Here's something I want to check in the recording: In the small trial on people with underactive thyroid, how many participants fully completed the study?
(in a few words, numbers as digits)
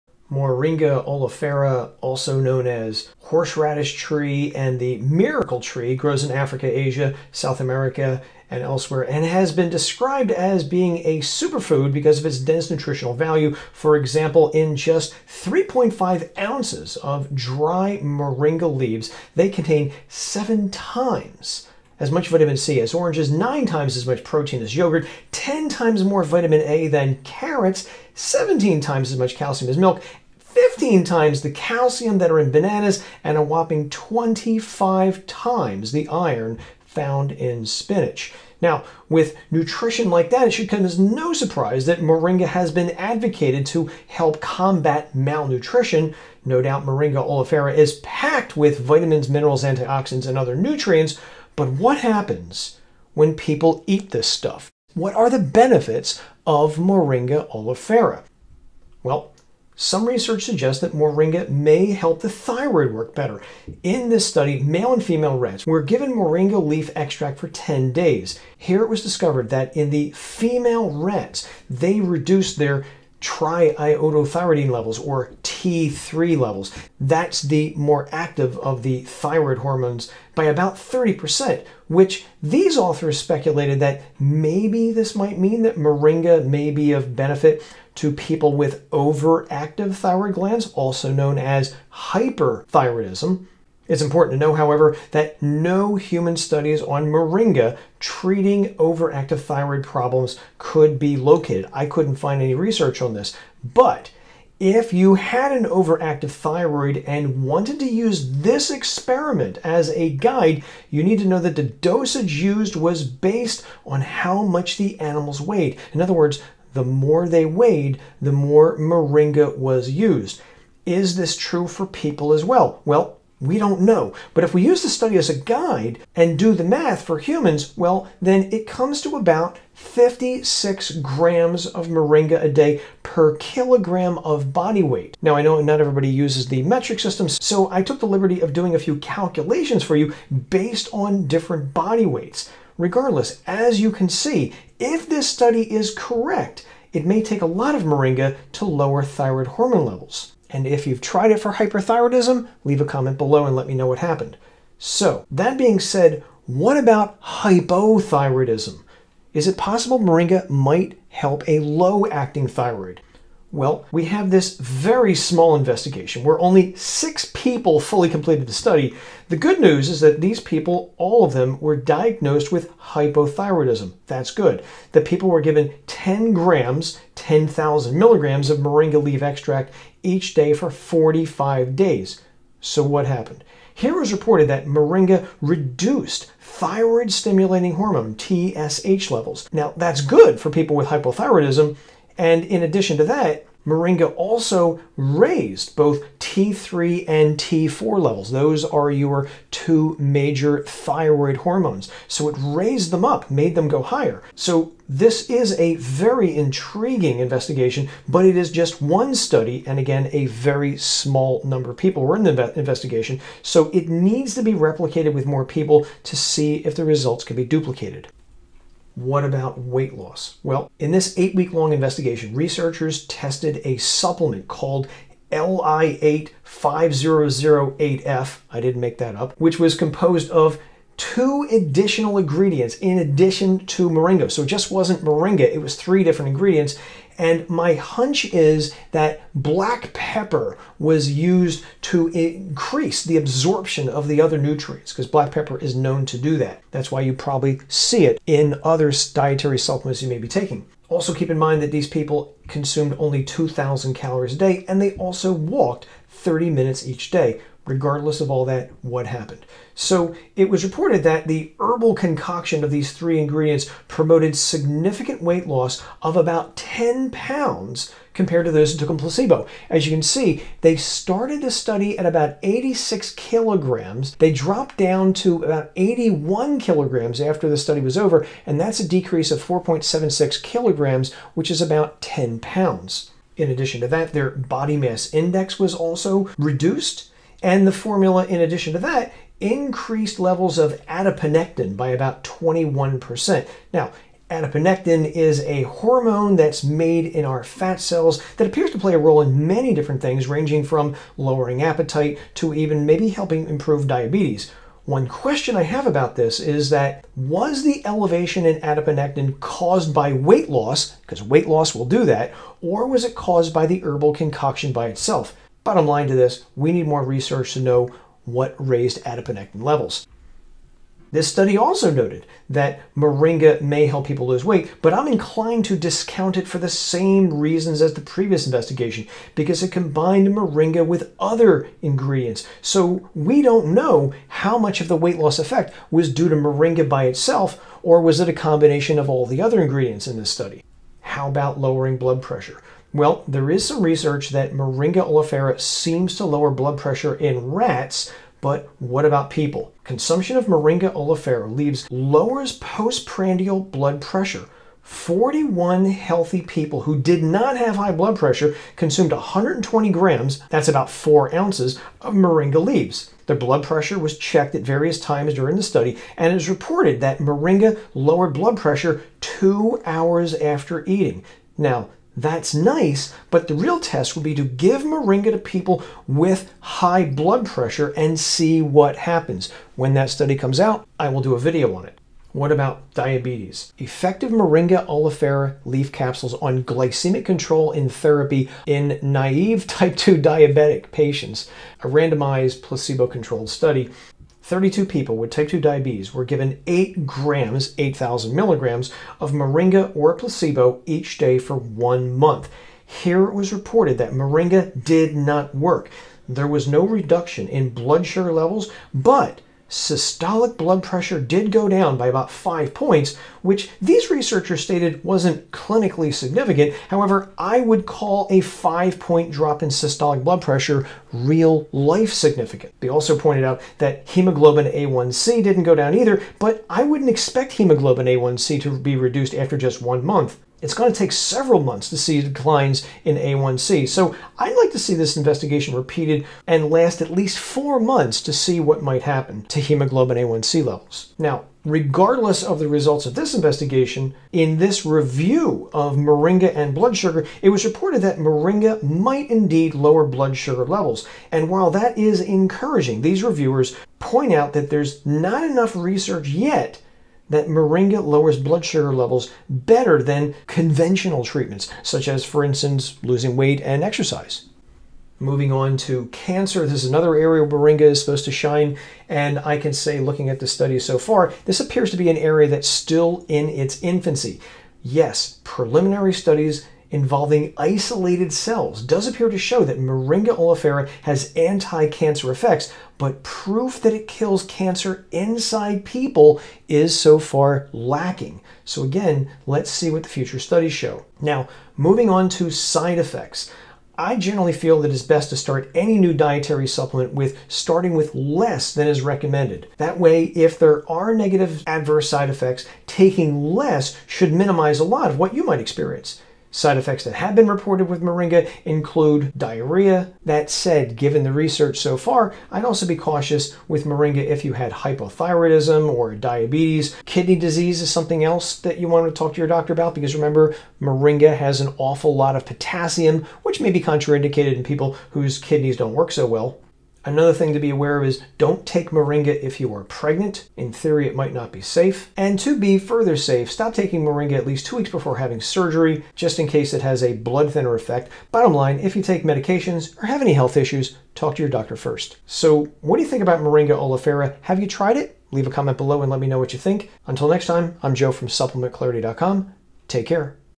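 six.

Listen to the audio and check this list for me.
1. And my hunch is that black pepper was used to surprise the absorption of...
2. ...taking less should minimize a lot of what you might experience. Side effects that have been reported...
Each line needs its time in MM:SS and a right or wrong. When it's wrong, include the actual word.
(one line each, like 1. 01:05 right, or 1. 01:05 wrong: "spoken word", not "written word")
1. 03:57 wrong: "increase", not "surprise"
2. 08:22 right.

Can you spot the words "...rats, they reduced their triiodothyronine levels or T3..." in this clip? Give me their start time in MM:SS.
01:10.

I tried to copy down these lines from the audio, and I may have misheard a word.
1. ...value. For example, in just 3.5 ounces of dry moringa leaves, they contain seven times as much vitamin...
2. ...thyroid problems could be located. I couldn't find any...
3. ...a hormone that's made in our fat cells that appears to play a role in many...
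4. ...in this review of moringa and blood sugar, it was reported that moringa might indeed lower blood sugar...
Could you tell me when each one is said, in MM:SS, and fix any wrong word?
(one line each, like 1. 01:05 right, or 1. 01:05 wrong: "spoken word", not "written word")
1. 00:13 right
2. 01:39 right
3. 04:55 right
4. 07:24 right.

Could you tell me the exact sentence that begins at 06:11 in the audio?
Now, that's nice, but the real test would be to give moringa to people with high blood pressure and see what happens.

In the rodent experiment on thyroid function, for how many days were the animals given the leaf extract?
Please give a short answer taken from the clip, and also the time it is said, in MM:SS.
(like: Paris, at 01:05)
10 days, at 01:07.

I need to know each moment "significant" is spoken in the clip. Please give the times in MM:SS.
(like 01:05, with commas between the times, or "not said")
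04:24, 06:56, 07:02.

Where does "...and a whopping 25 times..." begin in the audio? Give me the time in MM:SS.
00:33.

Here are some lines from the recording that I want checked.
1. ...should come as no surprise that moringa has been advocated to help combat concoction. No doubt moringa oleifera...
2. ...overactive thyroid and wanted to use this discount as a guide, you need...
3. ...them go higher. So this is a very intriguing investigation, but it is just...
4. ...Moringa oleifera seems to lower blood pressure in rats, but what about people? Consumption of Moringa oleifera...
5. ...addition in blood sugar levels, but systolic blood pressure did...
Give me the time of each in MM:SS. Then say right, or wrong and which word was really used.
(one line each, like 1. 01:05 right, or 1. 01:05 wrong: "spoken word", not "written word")
1. 00:40 wrong: "malnutrition", not "concoction"
2. 01:45 wrong: "experiment", not "discount"
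3. 03:23 right
4. 05:44 right
5. 06:46 wrong: "reduction", not "addition".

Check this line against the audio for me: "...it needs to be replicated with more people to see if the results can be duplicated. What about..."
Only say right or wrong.
right.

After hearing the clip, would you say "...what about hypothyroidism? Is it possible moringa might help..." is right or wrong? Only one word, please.
right.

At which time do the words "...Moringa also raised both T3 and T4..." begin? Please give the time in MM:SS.
03:13.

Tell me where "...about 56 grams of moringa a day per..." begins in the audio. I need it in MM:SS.
02:09.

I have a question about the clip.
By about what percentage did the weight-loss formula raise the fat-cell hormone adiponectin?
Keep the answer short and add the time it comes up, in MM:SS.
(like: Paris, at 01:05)
21%, at 04:52.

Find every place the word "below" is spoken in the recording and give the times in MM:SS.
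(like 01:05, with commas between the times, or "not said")
02:33, 09:05.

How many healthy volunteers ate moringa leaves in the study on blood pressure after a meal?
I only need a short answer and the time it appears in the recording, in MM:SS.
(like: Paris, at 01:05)
41, at 05:54.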